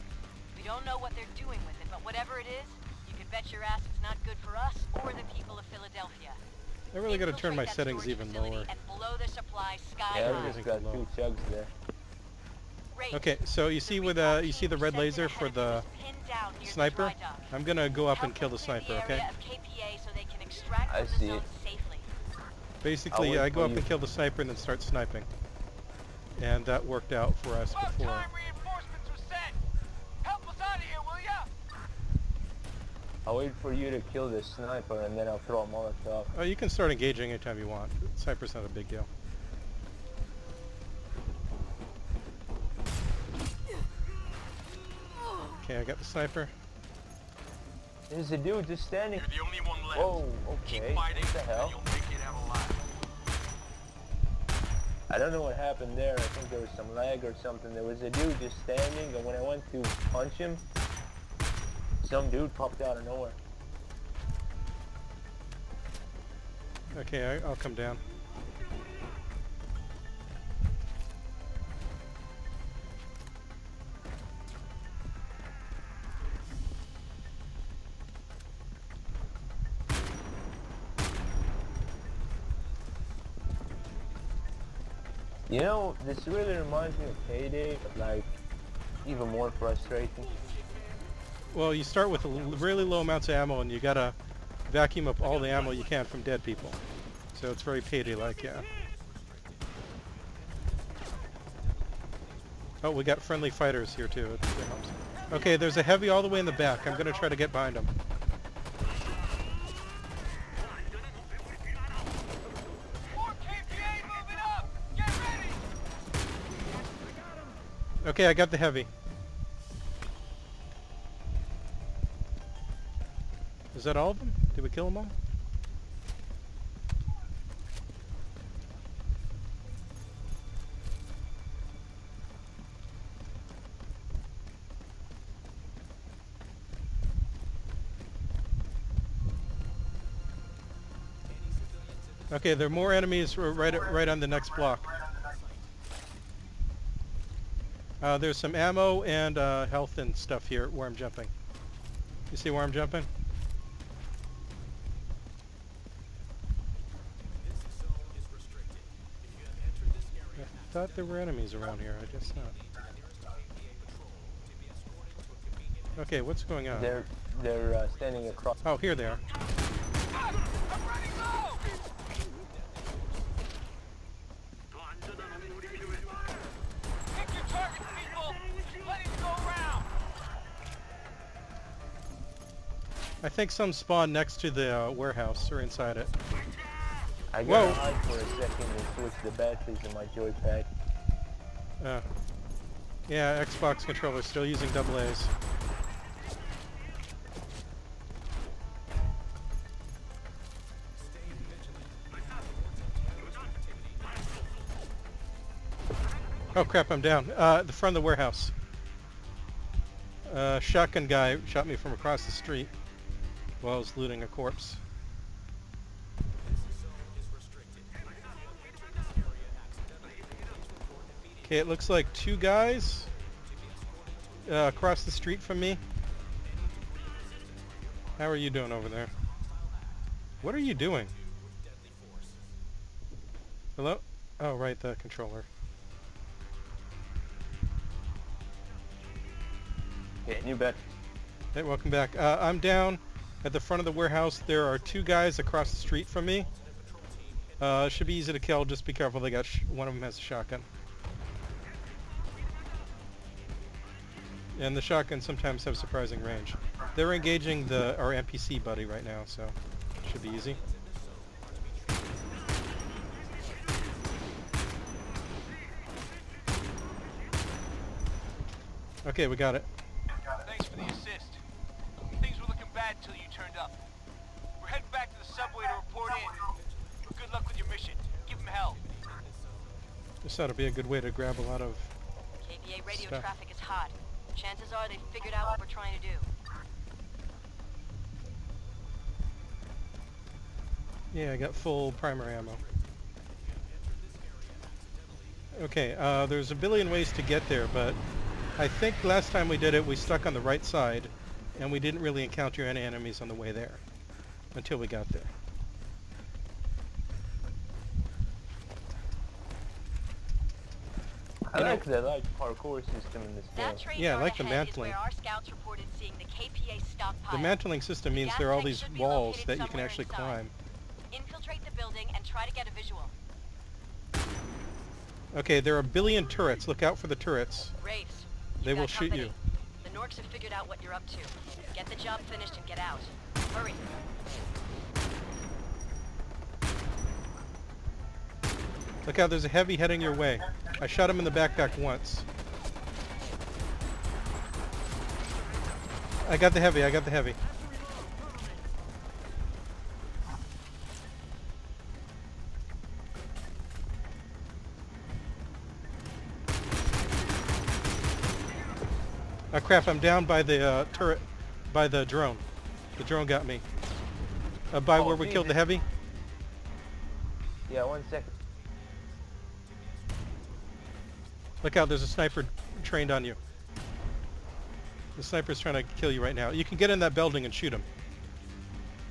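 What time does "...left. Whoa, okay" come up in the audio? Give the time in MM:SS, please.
00:49.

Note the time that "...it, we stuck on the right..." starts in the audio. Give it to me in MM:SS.
04:59.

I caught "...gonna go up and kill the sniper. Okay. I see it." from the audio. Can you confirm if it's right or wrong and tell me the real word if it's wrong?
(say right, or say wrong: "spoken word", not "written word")
right.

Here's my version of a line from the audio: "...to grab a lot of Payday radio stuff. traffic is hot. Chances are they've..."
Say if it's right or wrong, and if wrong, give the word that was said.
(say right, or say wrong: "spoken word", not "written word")
wrong: "KPA", not "Payday".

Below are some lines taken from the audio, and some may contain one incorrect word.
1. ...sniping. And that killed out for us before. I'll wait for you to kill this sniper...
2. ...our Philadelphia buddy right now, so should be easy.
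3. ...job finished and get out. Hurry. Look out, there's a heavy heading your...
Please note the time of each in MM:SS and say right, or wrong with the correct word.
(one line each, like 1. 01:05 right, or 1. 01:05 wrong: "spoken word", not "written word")
1. 00:24 wrong: "worked", not "killed"
2. 04:17 wrong: "NPC", not "Philadelphia"
3. 05:31 right.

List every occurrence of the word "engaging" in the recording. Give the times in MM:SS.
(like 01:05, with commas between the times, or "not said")
00:36, 04:17.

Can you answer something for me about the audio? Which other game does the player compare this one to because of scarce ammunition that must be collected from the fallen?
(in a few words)
Payday.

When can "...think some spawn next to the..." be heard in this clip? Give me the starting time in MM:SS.
03:03.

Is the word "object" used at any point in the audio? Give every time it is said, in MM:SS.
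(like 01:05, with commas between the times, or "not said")
not said.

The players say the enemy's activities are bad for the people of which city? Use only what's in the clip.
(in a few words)
Philadelphia.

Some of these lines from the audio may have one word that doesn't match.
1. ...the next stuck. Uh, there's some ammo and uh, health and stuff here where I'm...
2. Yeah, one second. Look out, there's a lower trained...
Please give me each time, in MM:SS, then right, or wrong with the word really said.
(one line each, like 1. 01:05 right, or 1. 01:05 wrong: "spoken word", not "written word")
1. 02:24 wrong: "block", not "stuck"
2. 06:07 wrong: "sniper", not "lower".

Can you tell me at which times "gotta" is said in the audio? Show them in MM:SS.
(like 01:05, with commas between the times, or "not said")
00:07, 01:33.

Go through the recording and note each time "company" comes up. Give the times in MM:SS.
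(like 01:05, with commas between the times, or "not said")
05:28.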